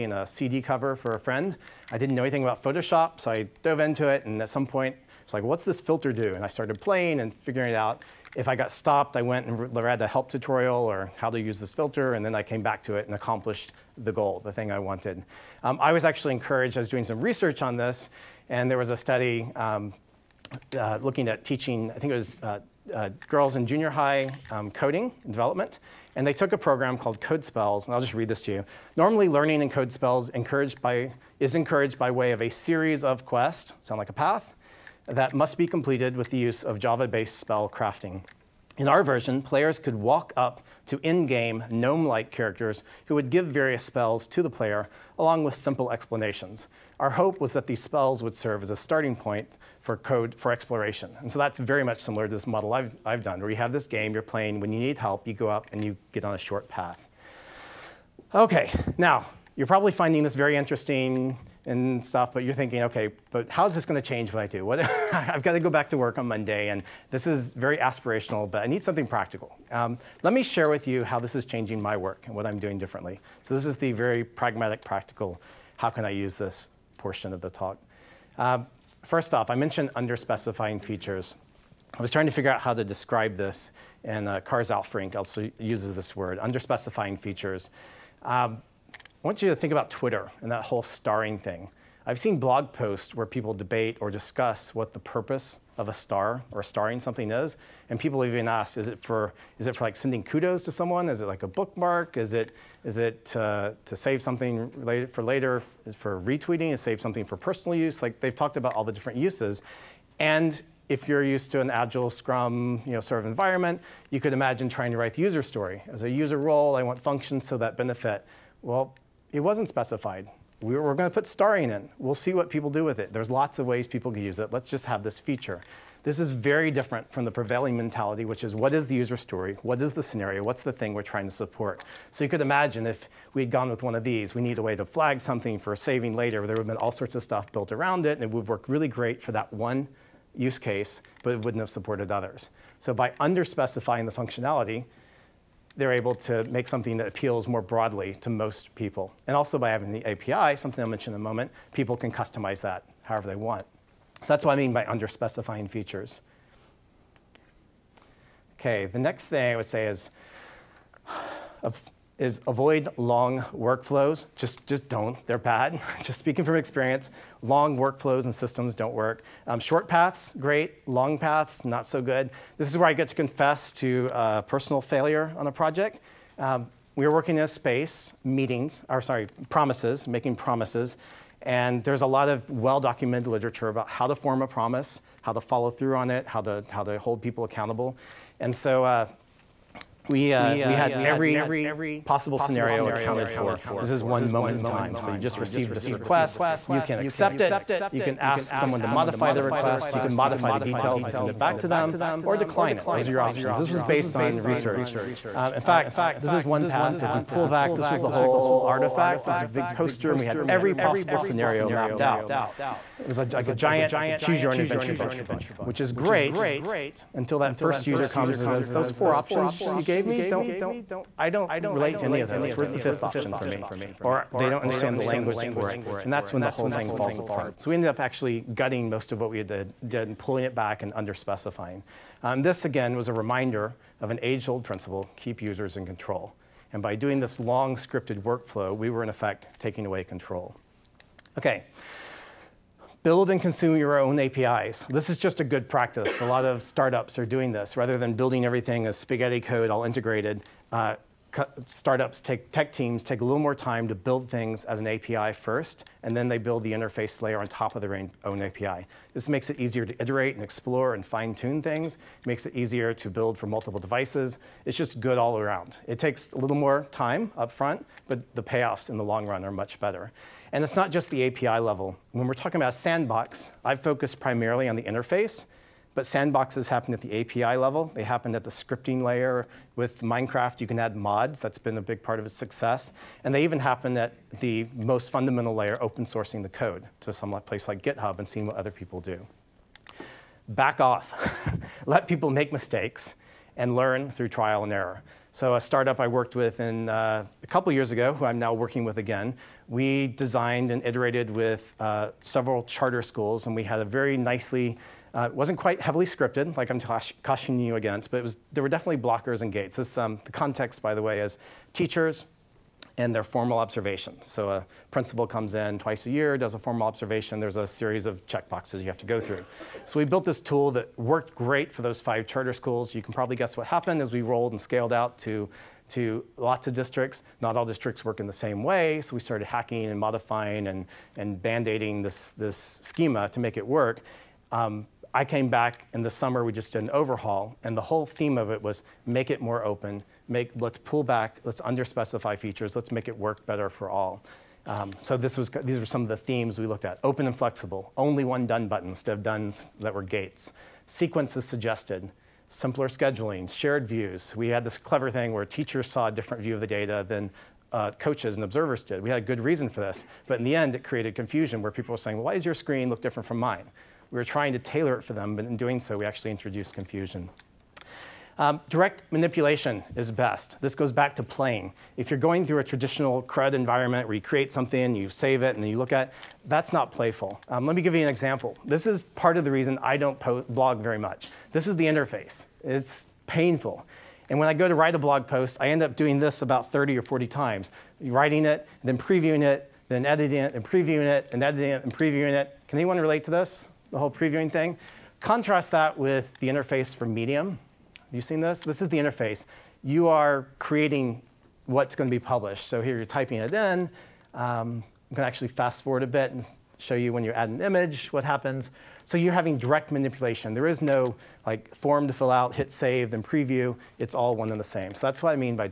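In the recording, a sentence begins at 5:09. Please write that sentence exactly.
This, um, the context, by the way, is teachers and their formal observations.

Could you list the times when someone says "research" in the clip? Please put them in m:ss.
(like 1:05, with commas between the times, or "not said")
0:17, 3:24.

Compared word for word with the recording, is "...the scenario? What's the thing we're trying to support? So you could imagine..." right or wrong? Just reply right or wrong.
right.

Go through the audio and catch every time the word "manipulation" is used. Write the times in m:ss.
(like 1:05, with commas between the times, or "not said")
6:09, 6:49.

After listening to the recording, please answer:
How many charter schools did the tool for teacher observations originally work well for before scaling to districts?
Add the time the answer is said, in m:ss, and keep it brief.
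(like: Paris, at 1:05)
5, at 5:22.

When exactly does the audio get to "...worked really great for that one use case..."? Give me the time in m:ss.
2:18.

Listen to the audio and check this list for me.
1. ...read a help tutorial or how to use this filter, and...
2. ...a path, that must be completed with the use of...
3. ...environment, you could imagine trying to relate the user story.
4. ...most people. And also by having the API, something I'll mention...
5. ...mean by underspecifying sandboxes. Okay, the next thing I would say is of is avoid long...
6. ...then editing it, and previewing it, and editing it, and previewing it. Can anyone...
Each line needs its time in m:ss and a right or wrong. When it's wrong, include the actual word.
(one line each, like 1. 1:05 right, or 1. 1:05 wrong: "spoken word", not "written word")
1. 0:09 right
2. 0:34 right
3. 1:53 wrong: "write", not "relate"
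4. 2:28 right
5. 2:34 wrong: "features", not "sandboxes"
6. 6:29 right.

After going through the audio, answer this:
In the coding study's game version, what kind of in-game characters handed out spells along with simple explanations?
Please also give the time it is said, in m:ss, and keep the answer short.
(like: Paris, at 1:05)
gnome-like characters, at 0:41.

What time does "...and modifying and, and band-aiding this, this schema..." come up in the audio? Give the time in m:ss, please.
5:29.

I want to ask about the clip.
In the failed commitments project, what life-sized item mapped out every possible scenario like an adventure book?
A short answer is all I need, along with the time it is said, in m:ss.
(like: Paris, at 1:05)
a big poster, at 3:29.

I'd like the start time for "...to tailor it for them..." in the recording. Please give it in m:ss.
6:04.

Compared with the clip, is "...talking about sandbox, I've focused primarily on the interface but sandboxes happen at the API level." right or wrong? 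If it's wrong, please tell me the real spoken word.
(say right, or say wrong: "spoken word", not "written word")
right.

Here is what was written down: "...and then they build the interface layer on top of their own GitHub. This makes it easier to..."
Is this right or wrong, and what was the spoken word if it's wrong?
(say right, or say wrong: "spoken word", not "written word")
wrong: "API", not "GitHub".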